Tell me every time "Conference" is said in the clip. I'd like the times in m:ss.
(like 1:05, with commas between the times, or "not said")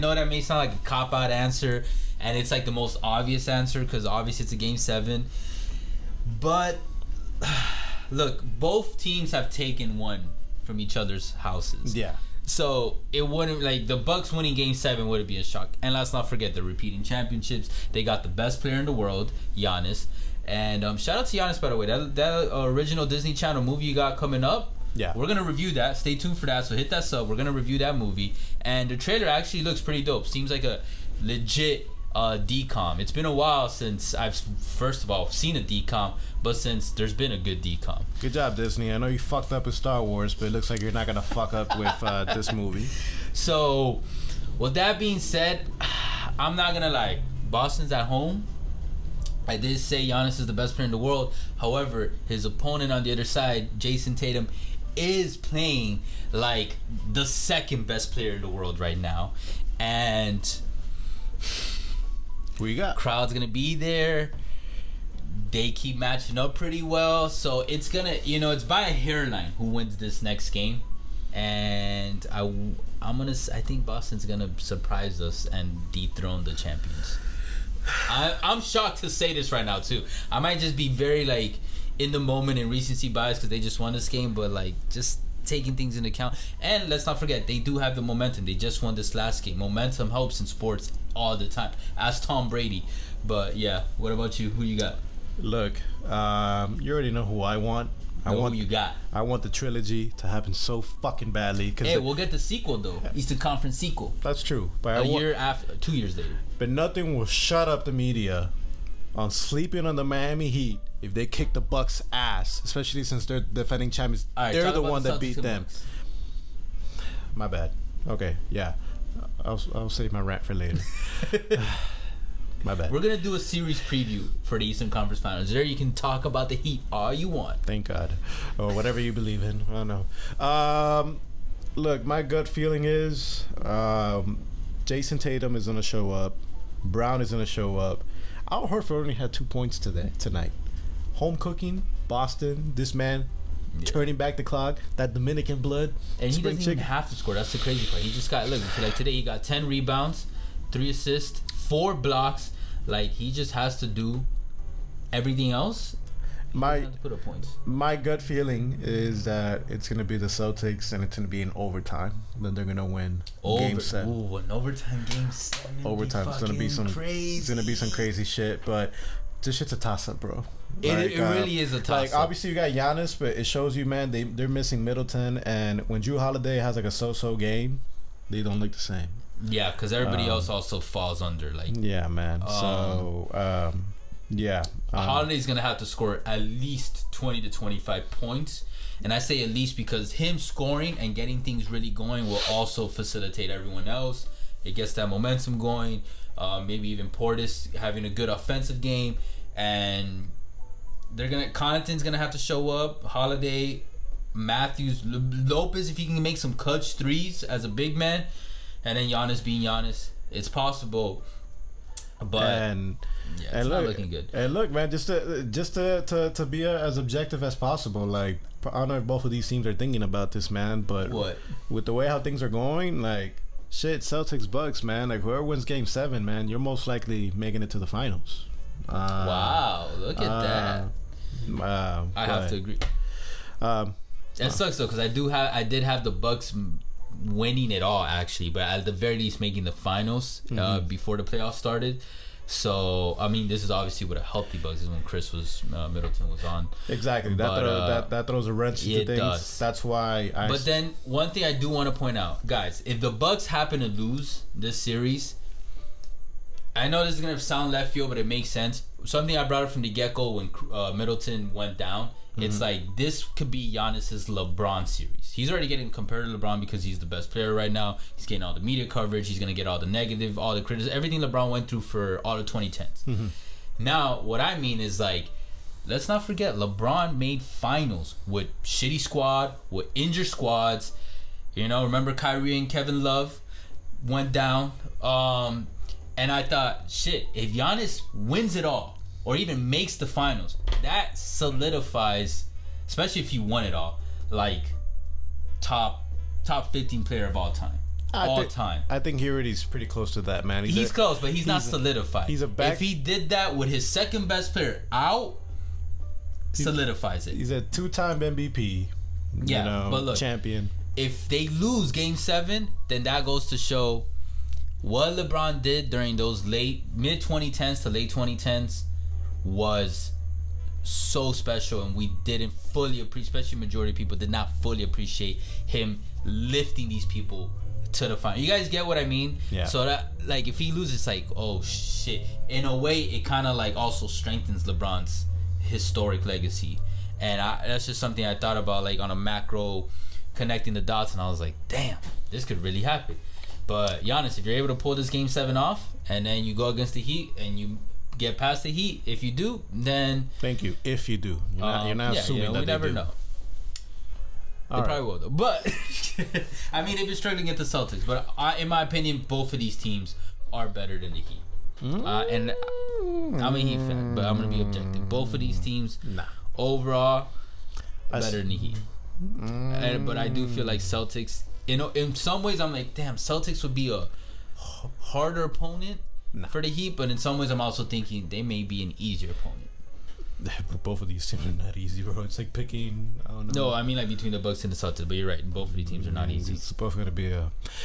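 1:43, 2:04.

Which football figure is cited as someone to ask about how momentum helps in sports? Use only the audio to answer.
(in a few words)
Tom Brady.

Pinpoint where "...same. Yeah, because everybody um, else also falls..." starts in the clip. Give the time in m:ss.
2:58.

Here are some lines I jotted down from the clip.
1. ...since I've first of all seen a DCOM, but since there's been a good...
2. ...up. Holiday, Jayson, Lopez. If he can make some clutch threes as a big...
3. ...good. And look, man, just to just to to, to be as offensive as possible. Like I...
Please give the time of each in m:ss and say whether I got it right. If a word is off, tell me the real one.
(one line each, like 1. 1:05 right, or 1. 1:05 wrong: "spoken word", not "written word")
1. 0:33 right
2. 3:22 wrong: "Matthews", not "Jayson"
3. 3:34 wrong: "objective", not "offensive".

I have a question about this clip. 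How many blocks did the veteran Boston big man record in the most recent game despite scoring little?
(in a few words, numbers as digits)
4.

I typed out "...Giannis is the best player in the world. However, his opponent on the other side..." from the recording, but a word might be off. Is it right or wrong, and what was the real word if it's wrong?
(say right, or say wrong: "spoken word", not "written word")
right.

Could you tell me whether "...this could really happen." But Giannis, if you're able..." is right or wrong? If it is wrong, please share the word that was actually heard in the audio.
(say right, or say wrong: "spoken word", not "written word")
right.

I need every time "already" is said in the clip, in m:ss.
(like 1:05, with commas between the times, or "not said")
1:36, 4:25, 4:59.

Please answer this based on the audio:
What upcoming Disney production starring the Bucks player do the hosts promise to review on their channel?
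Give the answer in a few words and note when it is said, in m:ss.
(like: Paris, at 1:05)
original Disney Channel movie, at 0:22.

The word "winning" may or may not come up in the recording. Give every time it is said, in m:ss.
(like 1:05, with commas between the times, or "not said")
0:14, 3:57.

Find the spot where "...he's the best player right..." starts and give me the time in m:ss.
4:26.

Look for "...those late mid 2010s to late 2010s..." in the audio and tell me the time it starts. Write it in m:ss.
5:16.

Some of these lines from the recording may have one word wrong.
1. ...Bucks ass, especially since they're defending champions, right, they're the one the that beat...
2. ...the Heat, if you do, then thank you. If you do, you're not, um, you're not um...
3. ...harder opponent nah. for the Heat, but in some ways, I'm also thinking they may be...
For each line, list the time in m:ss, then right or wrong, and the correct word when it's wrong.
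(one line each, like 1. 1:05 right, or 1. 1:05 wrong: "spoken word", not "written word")
1. 1:51 right
2. 5:48 right
3. 6:14 right.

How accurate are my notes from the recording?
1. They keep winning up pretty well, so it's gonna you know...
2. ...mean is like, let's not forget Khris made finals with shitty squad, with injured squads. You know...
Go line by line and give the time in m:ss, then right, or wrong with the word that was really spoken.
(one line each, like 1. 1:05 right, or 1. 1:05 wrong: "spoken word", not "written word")
1. 1:05 wrong: "matching", not "winning"
2. 4:34 wrong: "LeBron", not "Khris".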